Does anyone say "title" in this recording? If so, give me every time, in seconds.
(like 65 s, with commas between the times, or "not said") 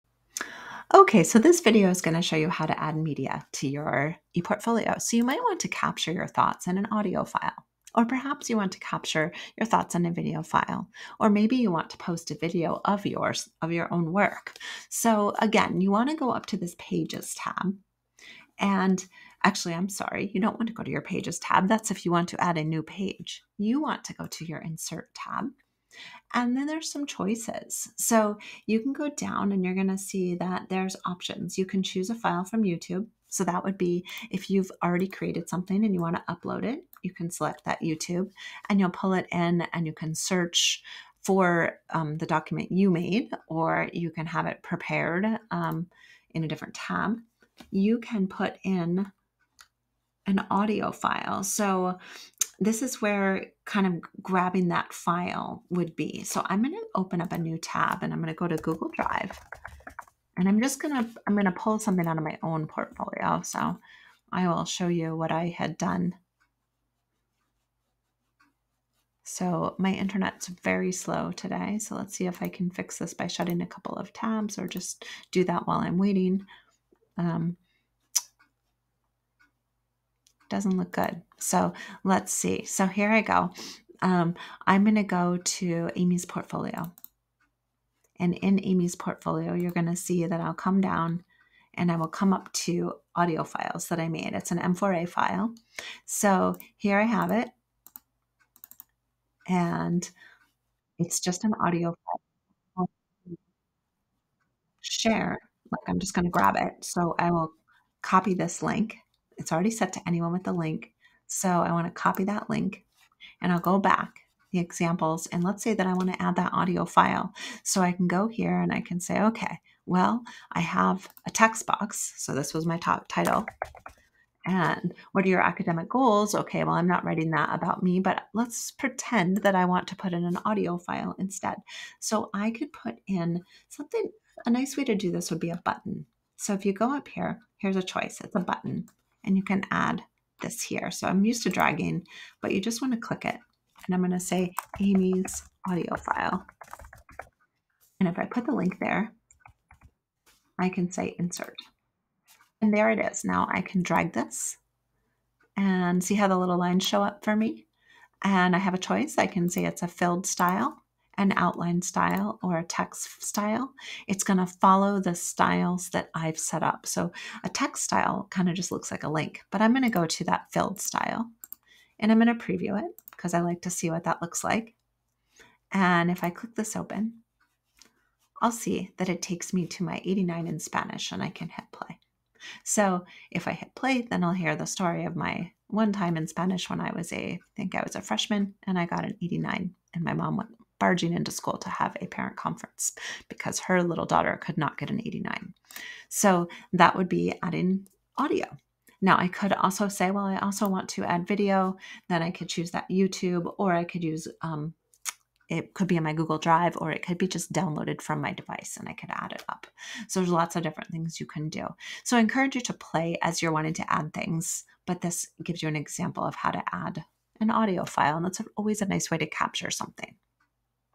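123 s.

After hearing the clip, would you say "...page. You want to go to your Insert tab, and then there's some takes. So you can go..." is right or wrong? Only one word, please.
wrong.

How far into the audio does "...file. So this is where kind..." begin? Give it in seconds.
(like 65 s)
50 s.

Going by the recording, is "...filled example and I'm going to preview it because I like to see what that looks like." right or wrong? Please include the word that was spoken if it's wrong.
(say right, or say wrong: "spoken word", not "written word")
wrong: "style", not "example".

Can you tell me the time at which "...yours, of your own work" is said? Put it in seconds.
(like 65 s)
13 s.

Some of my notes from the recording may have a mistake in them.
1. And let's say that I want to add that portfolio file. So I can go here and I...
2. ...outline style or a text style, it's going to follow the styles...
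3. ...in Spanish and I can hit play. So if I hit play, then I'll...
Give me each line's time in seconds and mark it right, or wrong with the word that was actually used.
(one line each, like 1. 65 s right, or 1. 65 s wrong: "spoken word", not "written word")
1. 115 s wrong: "audio", not "portfolio"
2. 161 s right
3. 180 s right.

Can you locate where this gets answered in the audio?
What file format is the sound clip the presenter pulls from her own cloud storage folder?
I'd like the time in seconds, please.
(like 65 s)
94 s.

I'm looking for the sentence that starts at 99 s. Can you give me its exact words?
And it's just an audio file.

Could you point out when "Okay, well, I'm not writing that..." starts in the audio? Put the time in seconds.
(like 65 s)
126 s.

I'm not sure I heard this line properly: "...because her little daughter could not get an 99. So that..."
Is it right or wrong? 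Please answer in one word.
wrong.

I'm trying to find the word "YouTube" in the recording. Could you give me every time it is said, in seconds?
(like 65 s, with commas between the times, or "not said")
32 s, 37 s, 202 s.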